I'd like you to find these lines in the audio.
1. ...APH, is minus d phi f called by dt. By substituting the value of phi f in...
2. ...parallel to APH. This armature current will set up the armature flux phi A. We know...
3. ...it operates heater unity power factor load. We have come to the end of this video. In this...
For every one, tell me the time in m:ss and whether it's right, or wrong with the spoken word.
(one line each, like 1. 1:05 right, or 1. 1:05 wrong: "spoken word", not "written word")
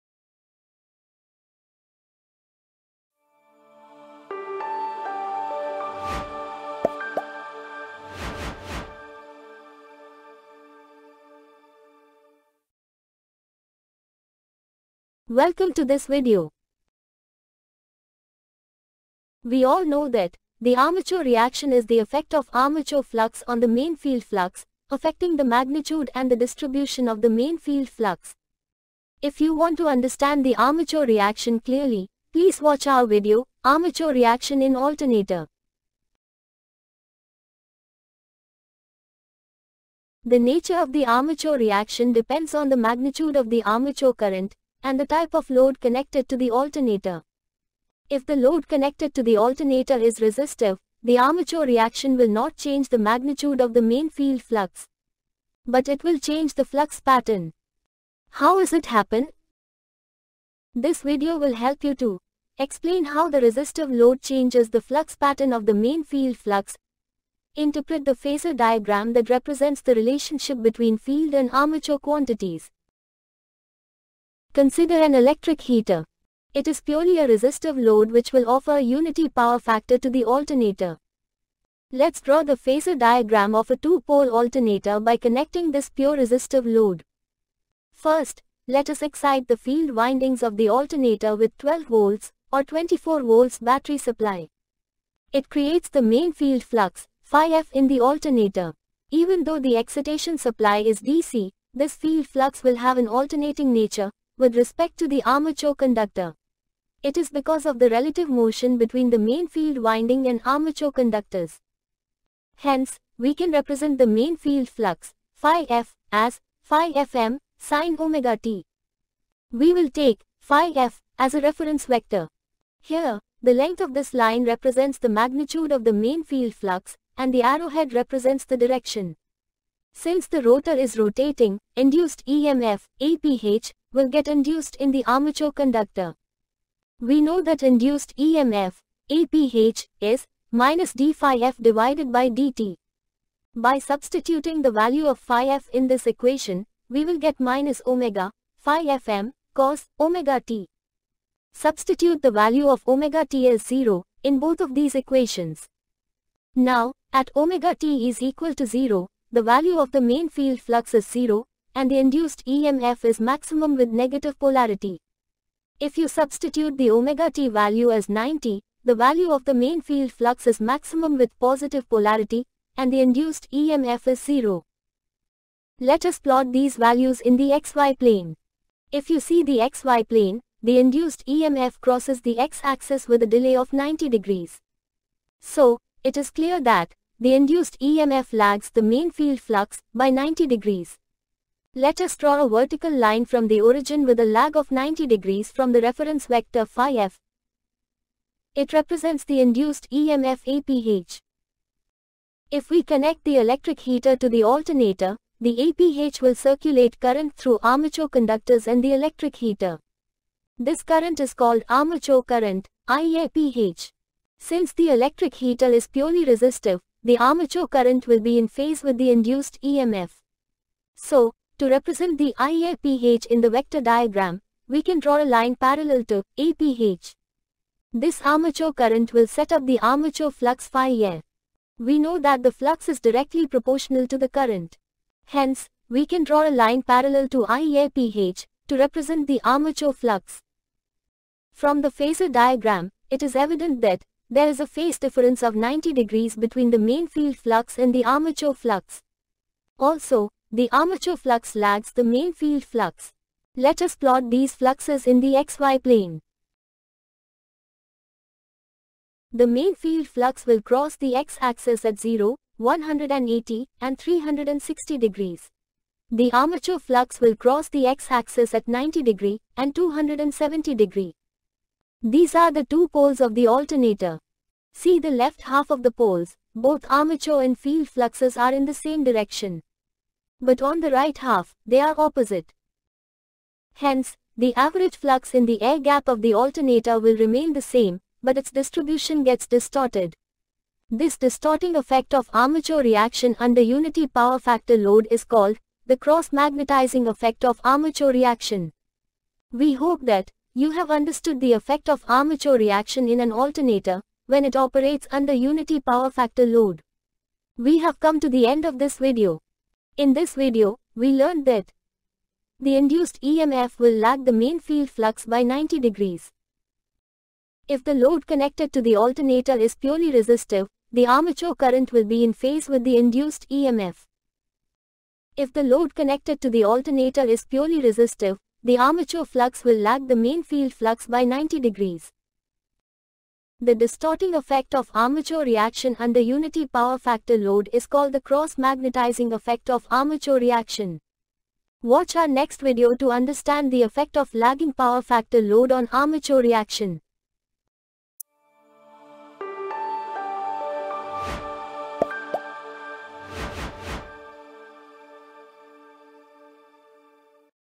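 1. 2:19 wrong: "divided", not "called"
2. 3:45 right
3. 5:04 wrong: "under", not "heater".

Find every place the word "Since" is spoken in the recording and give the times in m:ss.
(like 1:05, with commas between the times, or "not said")
2:09, 3:34.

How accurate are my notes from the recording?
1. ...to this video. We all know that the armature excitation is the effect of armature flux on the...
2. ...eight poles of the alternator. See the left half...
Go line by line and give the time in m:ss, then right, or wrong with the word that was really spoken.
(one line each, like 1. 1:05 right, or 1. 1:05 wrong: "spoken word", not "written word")
1. 0:15 wrong: "reaction", not "excitation"
2. 4:32 wrong: "two", not "eight".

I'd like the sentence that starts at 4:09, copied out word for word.
Also, the armature flux lags the main field flux.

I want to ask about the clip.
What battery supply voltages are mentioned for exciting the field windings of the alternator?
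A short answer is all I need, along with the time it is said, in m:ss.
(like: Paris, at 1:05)
12 or 24 volts, at 1:31.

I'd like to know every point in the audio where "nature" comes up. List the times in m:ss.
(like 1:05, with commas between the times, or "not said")
0:40, 1:43.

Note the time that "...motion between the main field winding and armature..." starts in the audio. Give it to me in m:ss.
1:48.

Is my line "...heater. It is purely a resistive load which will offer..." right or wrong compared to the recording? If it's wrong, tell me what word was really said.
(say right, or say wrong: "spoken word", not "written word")
right.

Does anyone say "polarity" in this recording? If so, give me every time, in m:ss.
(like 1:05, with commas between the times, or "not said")
2:44, 2:51.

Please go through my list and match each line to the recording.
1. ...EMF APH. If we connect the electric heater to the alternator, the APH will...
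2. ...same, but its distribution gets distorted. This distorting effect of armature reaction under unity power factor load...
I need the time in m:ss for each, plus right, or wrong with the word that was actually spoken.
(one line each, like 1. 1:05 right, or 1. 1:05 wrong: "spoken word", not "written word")
1. 3:19 right
2. 4:47 right.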